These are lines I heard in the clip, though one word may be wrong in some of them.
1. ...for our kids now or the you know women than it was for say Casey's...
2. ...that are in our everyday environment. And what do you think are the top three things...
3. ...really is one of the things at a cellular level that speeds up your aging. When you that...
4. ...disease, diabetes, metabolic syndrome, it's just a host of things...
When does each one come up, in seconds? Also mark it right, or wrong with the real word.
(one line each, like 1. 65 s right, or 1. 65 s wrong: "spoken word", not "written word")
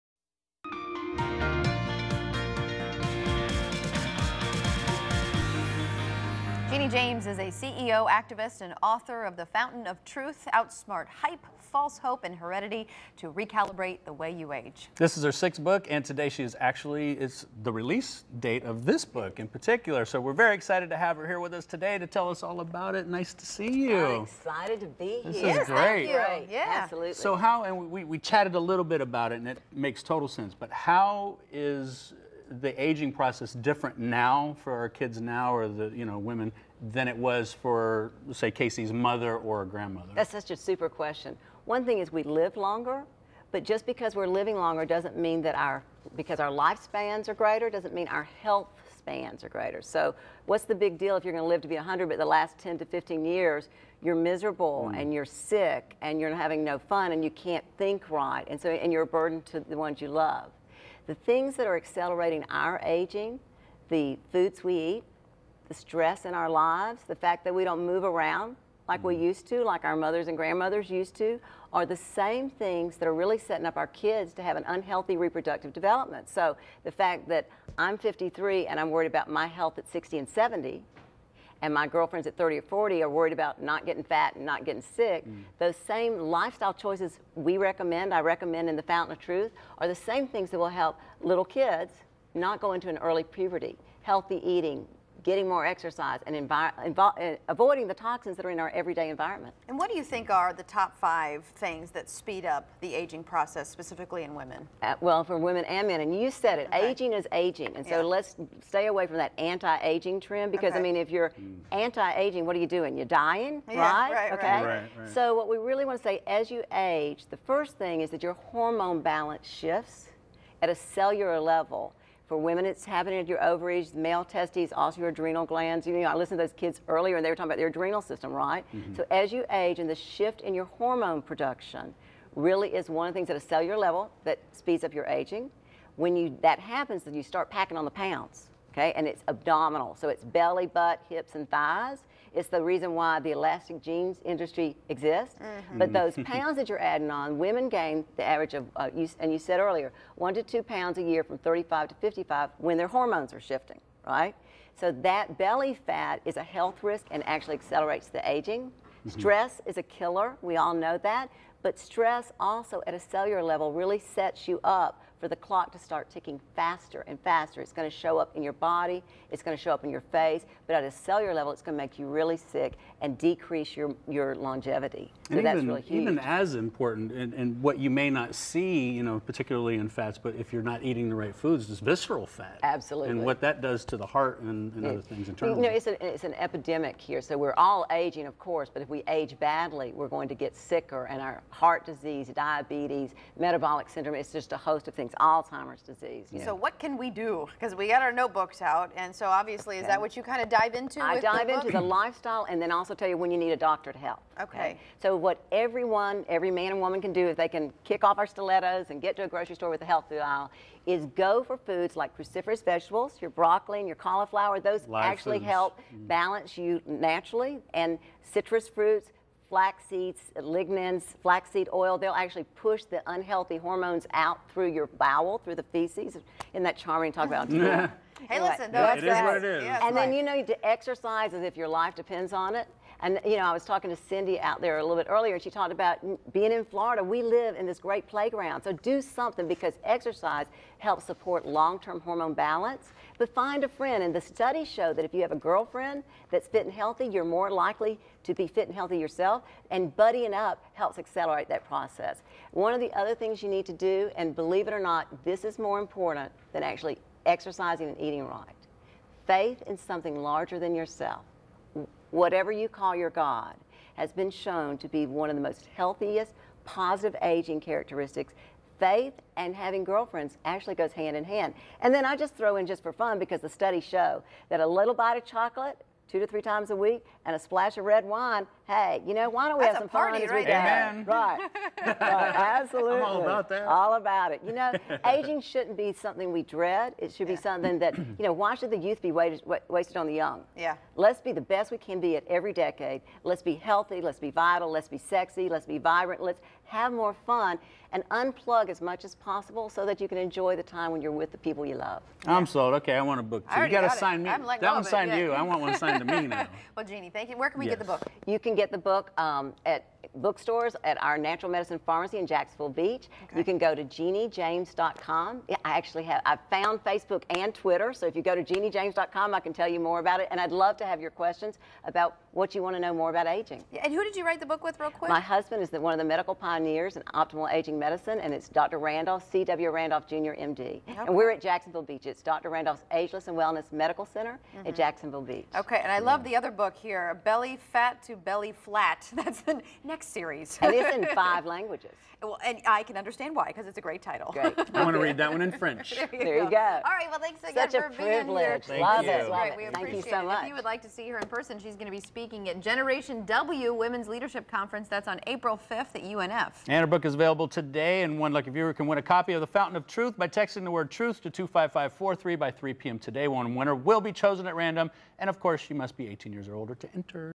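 1. 34 s right
2. 98 s wrong: "five", not "three"
3. 132 s right
4. 191 s right.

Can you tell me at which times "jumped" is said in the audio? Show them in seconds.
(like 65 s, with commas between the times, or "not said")
not said.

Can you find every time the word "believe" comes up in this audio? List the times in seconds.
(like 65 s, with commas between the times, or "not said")
254 s.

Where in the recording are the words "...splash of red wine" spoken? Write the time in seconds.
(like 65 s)
277 s.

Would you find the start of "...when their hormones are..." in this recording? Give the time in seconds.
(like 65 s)
152 s.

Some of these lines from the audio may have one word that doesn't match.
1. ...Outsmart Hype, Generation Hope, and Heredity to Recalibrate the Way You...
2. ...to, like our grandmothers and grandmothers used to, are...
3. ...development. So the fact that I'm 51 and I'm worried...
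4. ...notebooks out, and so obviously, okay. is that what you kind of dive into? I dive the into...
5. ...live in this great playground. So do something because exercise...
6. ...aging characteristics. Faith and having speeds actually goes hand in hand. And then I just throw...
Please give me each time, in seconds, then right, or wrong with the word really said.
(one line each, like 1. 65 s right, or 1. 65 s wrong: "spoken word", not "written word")
1. 10 s wrong: "False", not "Generation"
2. 69 s wrong: "mothers", not "grandmothers"
3. 75 s wrong: "53", not "51"
4. 198 s right
5. 237 s right
6. 267 s wrong: "girlfriends", not "speeds".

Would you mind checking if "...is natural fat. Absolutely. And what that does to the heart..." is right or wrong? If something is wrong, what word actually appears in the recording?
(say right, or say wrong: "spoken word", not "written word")
wrong: "visceral", not "natural".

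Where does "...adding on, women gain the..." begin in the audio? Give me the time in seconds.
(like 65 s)
146 s.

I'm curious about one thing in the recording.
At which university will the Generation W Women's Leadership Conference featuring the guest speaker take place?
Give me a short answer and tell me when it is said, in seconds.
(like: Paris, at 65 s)
UNF, at 356 s.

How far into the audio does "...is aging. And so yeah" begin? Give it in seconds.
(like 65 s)
107 s.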